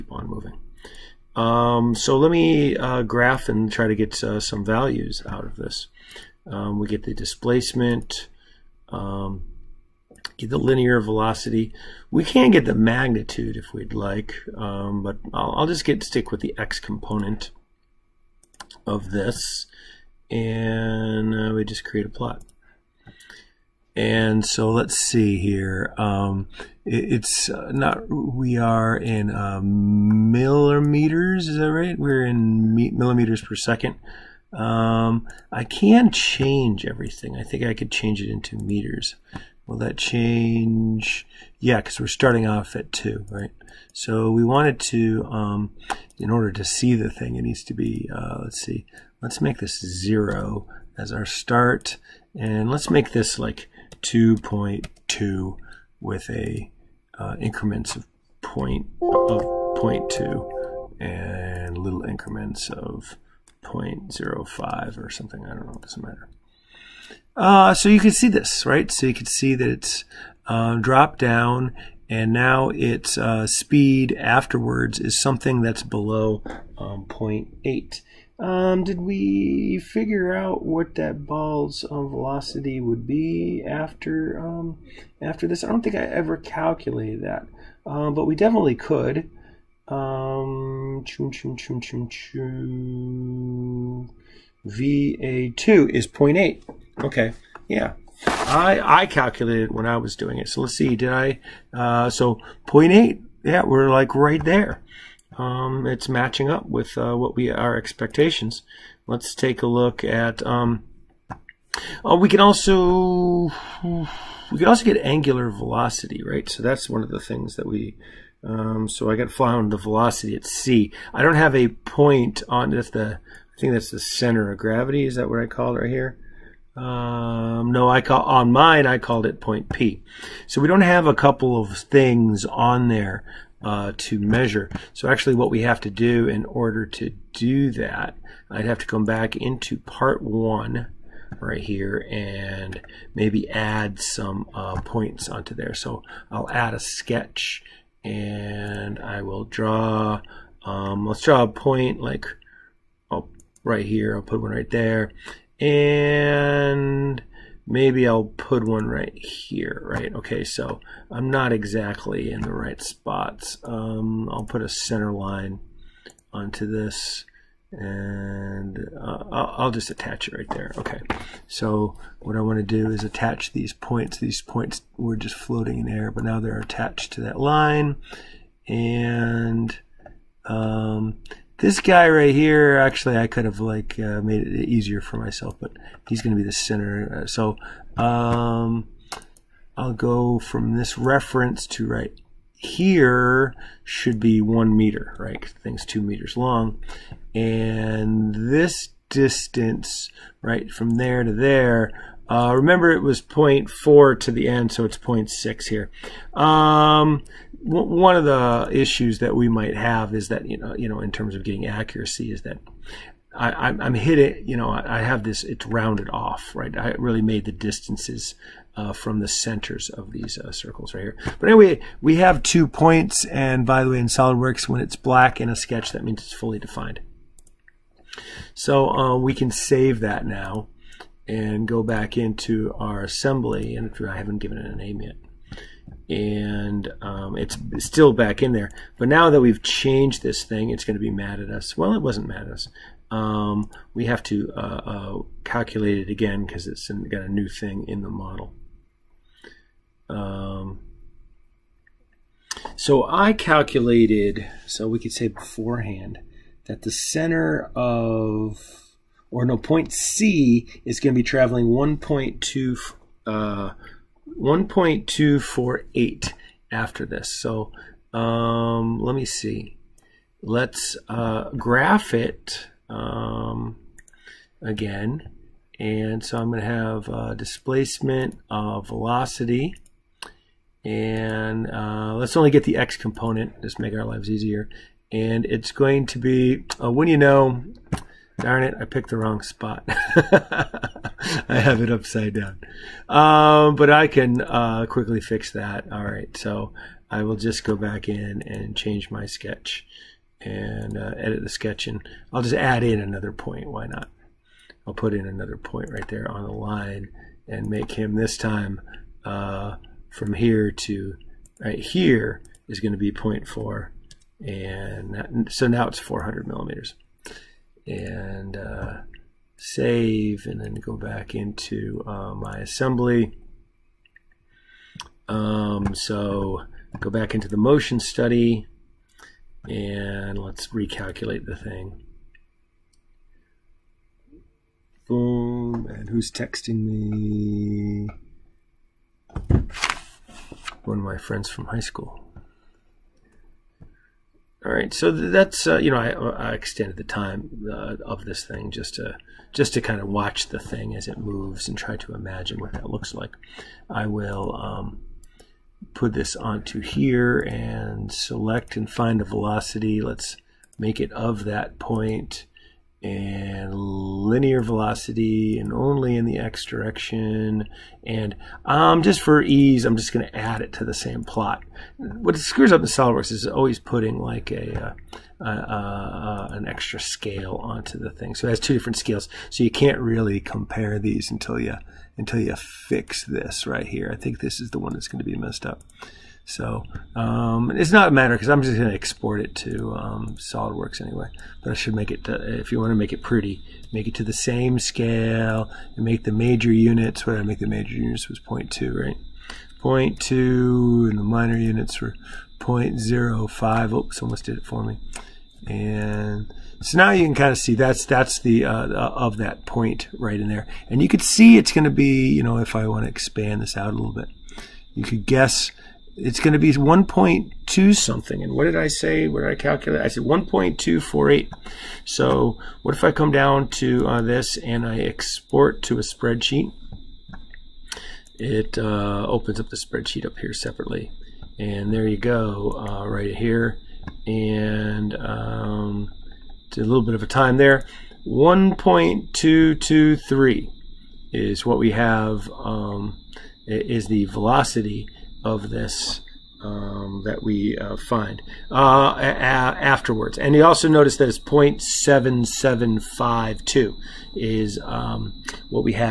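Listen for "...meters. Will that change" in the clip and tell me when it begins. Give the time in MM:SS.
00:38.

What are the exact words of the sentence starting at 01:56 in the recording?
So that's one of the things that we, um, so I got found the velocity at C.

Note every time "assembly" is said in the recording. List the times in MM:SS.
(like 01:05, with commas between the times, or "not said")
03:53, 05:22.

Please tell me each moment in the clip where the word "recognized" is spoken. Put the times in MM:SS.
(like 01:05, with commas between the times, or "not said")
not said.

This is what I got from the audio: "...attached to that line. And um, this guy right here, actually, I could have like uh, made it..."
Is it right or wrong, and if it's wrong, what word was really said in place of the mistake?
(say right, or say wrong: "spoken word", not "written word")
right.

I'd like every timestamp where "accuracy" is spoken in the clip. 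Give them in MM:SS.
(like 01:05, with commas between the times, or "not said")
03:31.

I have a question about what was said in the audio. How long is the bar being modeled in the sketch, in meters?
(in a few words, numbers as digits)
2 meters.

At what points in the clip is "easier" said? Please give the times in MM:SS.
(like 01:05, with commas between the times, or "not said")
03:04, 04:44.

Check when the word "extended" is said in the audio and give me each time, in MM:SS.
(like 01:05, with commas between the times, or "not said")
05:46.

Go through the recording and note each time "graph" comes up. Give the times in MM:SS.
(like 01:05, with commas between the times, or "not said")
00:03, 04:31.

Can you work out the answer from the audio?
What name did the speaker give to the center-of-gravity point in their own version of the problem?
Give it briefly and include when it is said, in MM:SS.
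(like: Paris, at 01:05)
Point P, at 02:09.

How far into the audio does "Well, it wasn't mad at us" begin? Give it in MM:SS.
04:01.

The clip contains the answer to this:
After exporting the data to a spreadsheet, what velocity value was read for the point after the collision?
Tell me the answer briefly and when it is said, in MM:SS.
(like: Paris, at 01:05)
1.223, at 07:18.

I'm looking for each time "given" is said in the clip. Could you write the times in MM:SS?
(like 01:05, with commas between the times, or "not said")
03:54.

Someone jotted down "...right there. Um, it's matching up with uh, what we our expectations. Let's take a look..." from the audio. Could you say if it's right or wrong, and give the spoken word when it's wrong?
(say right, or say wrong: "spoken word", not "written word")
right.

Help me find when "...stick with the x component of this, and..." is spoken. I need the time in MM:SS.
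00:16.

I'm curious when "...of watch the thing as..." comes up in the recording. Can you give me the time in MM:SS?
05:49.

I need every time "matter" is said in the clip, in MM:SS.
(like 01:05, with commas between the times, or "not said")
01:06, 06:28.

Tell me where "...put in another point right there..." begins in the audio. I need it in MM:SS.
05:04.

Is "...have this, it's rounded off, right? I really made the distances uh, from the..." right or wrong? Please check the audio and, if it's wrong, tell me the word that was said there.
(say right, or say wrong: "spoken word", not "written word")
right.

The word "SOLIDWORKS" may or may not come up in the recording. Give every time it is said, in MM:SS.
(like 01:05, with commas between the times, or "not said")
03:44, 06:12, 06:30.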